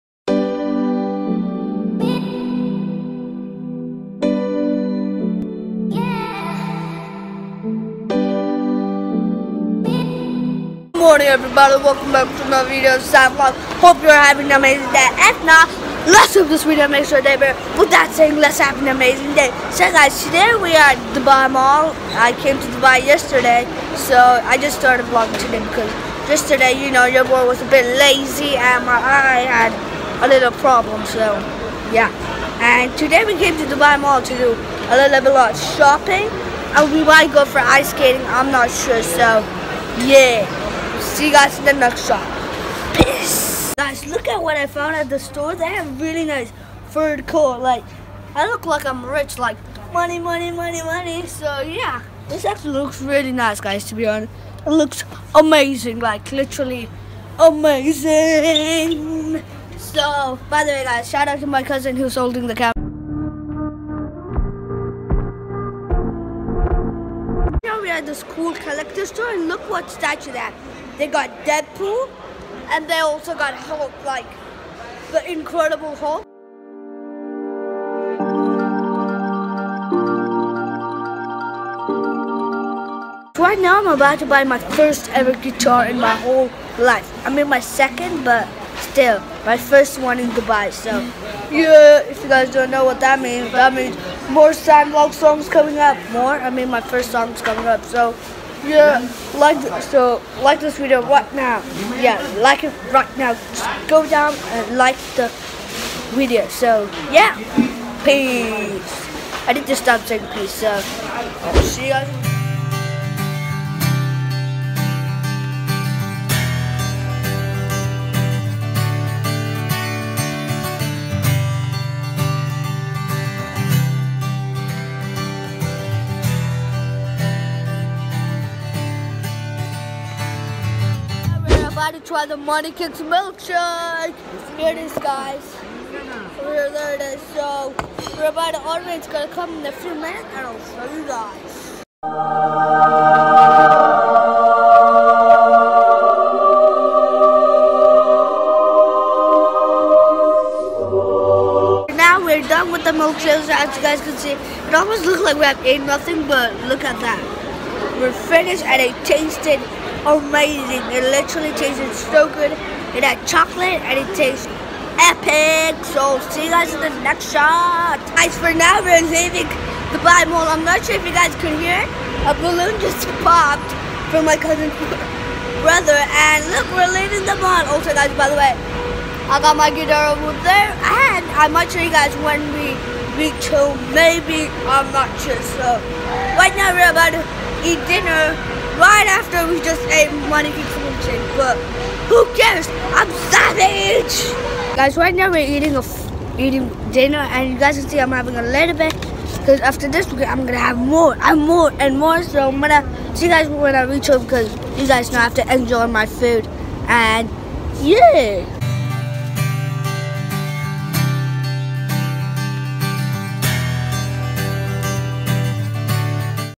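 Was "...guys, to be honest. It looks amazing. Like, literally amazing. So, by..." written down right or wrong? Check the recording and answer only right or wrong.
right.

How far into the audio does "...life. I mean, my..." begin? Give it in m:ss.
1:26.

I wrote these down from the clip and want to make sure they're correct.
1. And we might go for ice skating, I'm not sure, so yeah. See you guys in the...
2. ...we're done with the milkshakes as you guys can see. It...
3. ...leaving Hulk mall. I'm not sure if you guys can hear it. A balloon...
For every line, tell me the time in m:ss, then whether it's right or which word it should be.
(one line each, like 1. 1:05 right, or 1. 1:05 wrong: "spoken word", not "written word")
1. 0:36 right
2. 2:32 right
3. 2:49 wrong: "Dubai", not "Hulk".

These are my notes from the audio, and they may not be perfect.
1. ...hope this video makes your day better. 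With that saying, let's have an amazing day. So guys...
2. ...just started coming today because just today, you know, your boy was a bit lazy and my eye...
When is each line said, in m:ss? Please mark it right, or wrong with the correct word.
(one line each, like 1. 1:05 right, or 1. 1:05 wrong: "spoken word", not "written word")
1. 0:16 right
2. 0:24 wrong: "vlogging", not "coming".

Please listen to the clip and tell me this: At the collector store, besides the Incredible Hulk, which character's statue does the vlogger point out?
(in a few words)
Deadpool.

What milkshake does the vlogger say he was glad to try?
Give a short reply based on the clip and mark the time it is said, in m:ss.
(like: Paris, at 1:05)
Money Kicks, at 2:12.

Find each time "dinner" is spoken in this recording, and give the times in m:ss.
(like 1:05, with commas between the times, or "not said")
3:07, 3:16.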